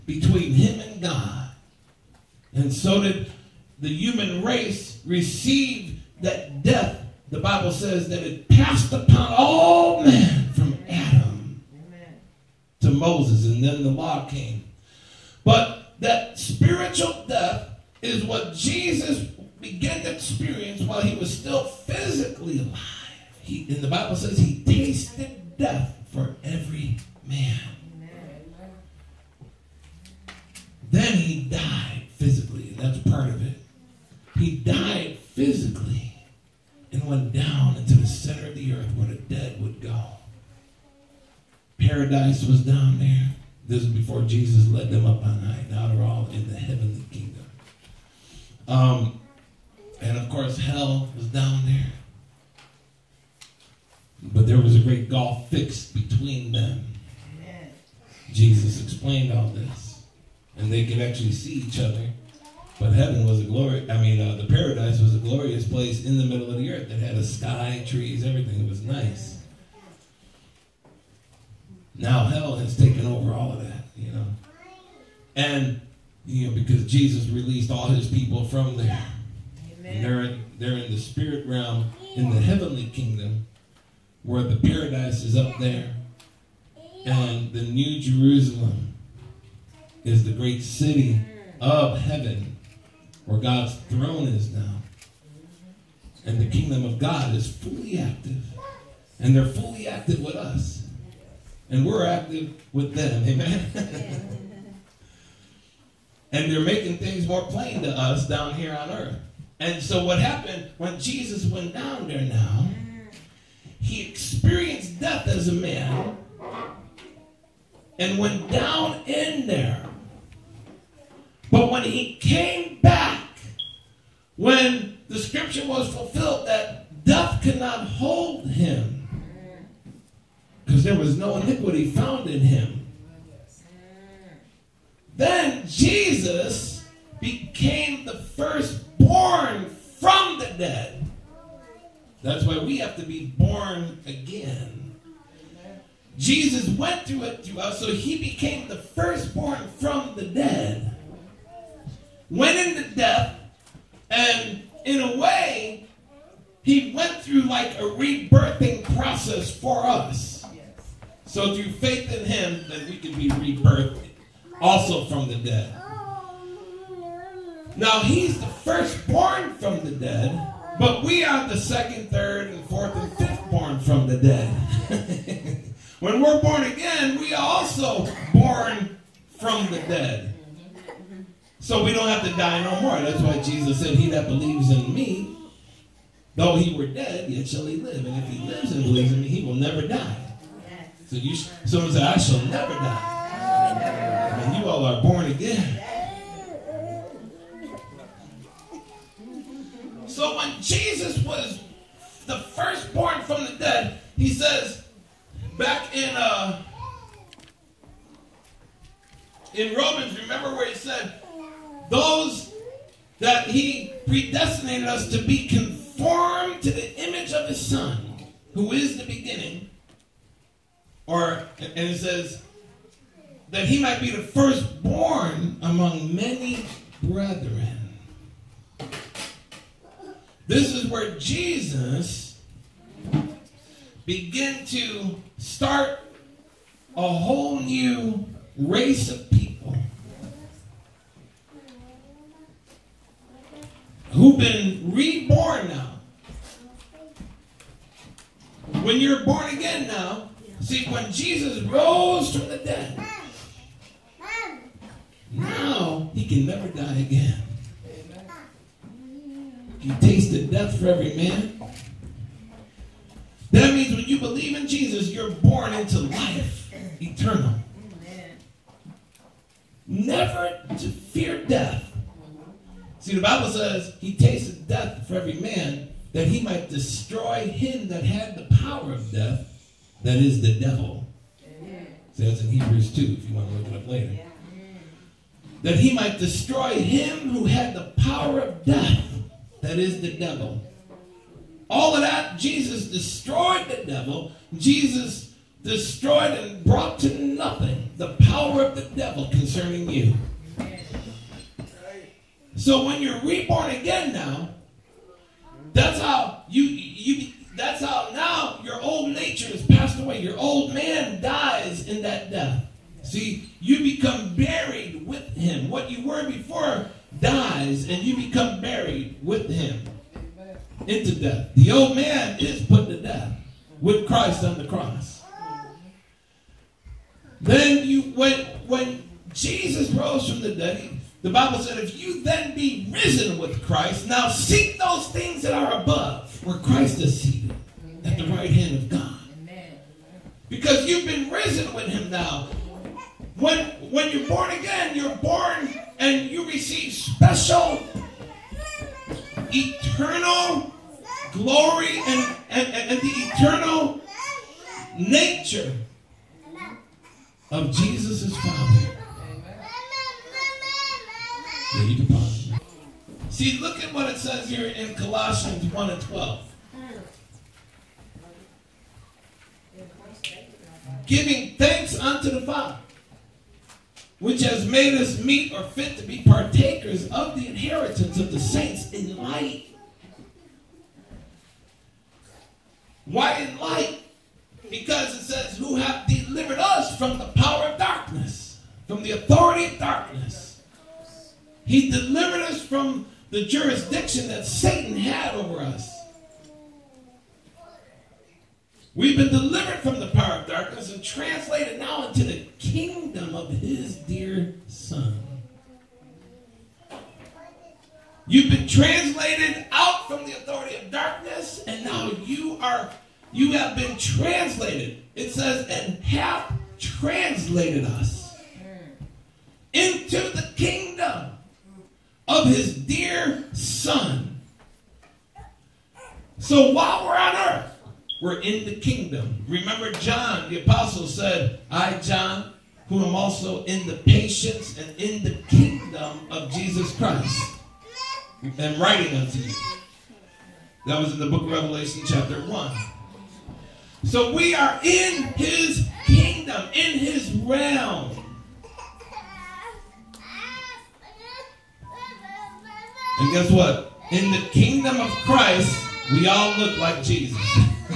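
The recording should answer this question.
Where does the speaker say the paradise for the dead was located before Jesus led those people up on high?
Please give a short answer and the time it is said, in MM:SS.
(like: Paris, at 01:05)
The middle of the earth, at 01:06.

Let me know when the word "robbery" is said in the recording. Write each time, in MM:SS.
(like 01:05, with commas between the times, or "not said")
not said.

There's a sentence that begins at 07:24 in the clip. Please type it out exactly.
So we are in his kingdom, in his realm.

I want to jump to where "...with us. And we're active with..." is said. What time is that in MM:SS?
01:40.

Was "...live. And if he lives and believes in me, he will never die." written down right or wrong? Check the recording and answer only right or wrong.
right.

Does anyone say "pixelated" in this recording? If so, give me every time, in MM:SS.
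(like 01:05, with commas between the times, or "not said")
not said.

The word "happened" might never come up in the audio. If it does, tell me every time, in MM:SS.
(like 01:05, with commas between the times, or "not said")
01:50.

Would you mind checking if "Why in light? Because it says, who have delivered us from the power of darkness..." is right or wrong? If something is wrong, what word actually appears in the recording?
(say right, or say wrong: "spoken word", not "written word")
right.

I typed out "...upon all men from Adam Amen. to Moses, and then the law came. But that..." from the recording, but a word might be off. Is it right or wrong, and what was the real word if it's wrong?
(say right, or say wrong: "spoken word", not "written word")
right.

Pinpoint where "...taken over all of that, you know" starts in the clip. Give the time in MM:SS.
01:12.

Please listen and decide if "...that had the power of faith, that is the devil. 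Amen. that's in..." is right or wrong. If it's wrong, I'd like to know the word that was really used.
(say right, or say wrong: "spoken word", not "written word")
wrong: "death", not "faith".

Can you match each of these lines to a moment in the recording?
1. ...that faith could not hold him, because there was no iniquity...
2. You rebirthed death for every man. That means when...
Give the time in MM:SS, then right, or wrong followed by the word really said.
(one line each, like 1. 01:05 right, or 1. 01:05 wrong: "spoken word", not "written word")
1. 02:06 wrong: "death", not "faith"
2. 04:19 wrong: "tasted", not "rebirthed".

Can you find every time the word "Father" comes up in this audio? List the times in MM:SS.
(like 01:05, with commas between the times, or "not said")
05:58, 06:12.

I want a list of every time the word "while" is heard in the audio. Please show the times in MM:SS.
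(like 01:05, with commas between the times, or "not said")
00:20, 07:06.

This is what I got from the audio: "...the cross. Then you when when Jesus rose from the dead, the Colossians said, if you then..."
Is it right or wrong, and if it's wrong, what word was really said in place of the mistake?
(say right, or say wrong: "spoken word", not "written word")
wrong: "Bible", not "Colossians".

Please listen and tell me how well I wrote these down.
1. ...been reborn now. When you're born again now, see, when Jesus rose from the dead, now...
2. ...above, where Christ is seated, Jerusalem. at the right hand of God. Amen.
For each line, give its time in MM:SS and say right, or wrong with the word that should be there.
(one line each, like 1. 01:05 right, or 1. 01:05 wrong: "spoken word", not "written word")
1. 04:04 right
2. 05:35 wrong: "Amen", not "Jerusalem".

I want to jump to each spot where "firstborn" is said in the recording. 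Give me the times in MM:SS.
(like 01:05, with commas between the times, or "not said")
02:18, 02:28, 02:48, 03:44.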